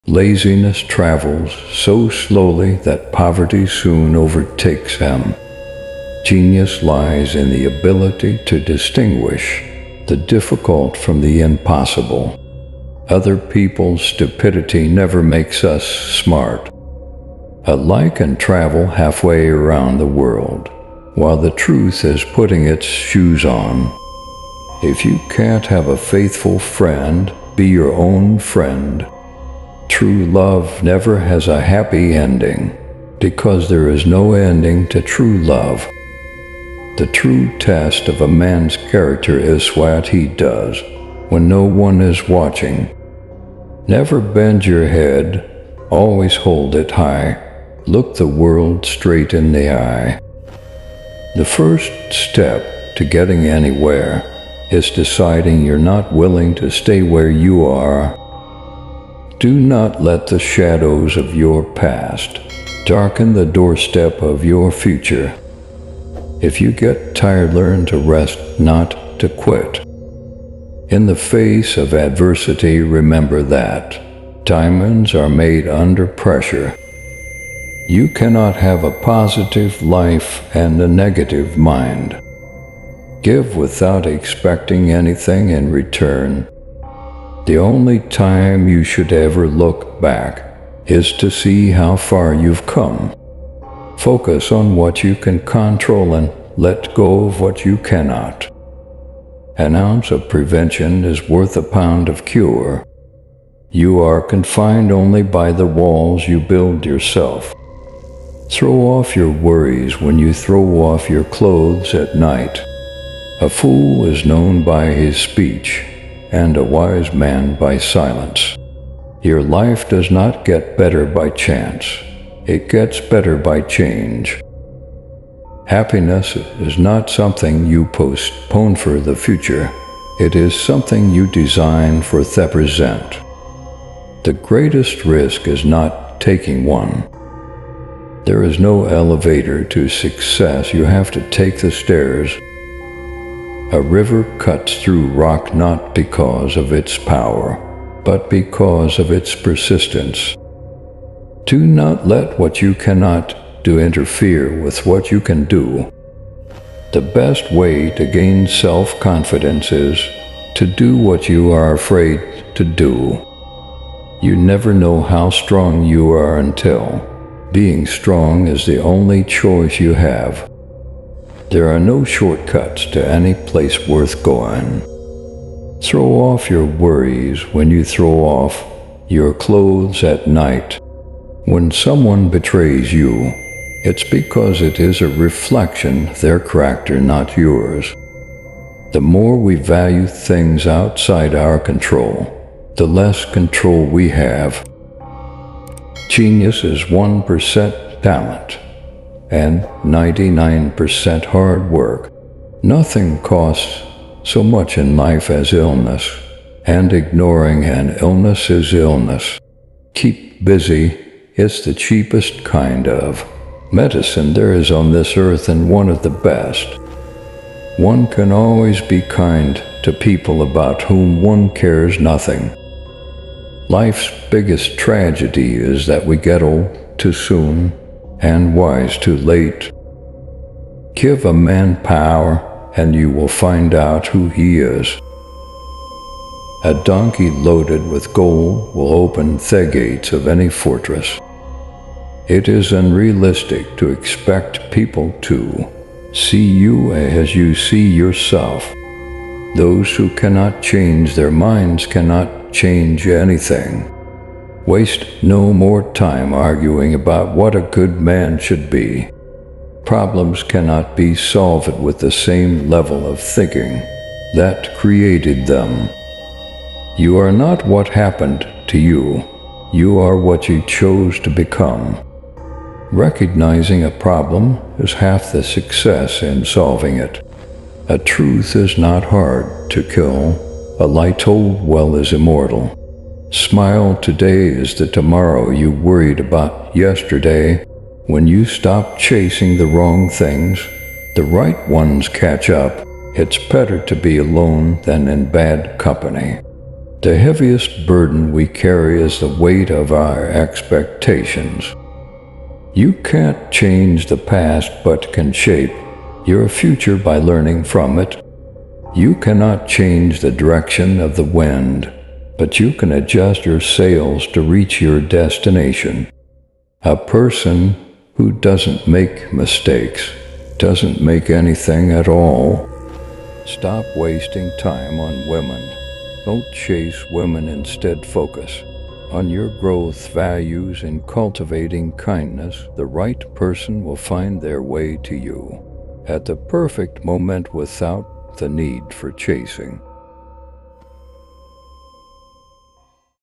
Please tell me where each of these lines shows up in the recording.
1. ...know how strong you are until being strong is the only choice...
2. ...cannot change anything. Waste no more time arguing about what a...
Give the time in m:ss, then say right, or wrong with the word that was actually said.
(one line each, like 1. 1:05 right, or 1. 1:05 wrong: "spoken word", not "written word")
1. 2:44 right
2. 4:11 right.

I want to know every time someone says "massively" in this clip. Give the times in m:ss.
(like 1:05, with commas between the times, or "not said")
not said.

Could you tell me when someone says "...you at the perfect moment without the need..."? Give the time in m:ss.
5:35.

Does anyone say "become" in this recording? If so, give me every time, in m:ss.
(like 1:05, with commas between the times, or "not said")
4:31.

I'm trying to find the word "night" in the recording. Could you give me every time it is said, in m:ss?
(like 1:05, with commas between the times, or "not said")
1:52, 3:00.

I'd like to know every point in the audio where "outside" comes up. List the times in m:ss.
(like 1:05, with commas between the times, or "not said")
3:10.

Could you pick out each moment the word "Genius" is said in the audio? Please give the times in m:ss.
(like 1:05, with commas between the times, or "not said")
0:06, 3:16.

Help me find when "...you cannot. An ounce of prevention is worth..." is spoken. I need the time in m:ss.
1:37.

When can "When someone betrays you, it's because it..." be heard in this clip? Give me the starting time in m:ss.
3:01.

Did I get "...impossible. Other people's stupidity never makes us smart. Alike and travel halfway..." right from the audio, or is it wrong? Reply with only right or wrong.
right.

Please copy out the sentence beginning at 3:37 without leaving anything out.
One can always be kind to people about whom one cares nothing.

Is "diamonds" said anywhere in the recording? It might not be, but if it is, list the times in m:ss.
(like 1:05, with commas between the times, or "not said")
1:14.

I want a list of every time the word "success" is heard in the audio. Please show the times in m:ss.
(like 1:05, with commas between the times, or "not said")
2:19, 4:35.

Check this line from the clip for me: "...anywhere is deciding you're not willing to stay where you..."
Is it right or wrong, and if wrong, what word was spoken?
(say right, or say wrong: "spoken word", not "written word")
right.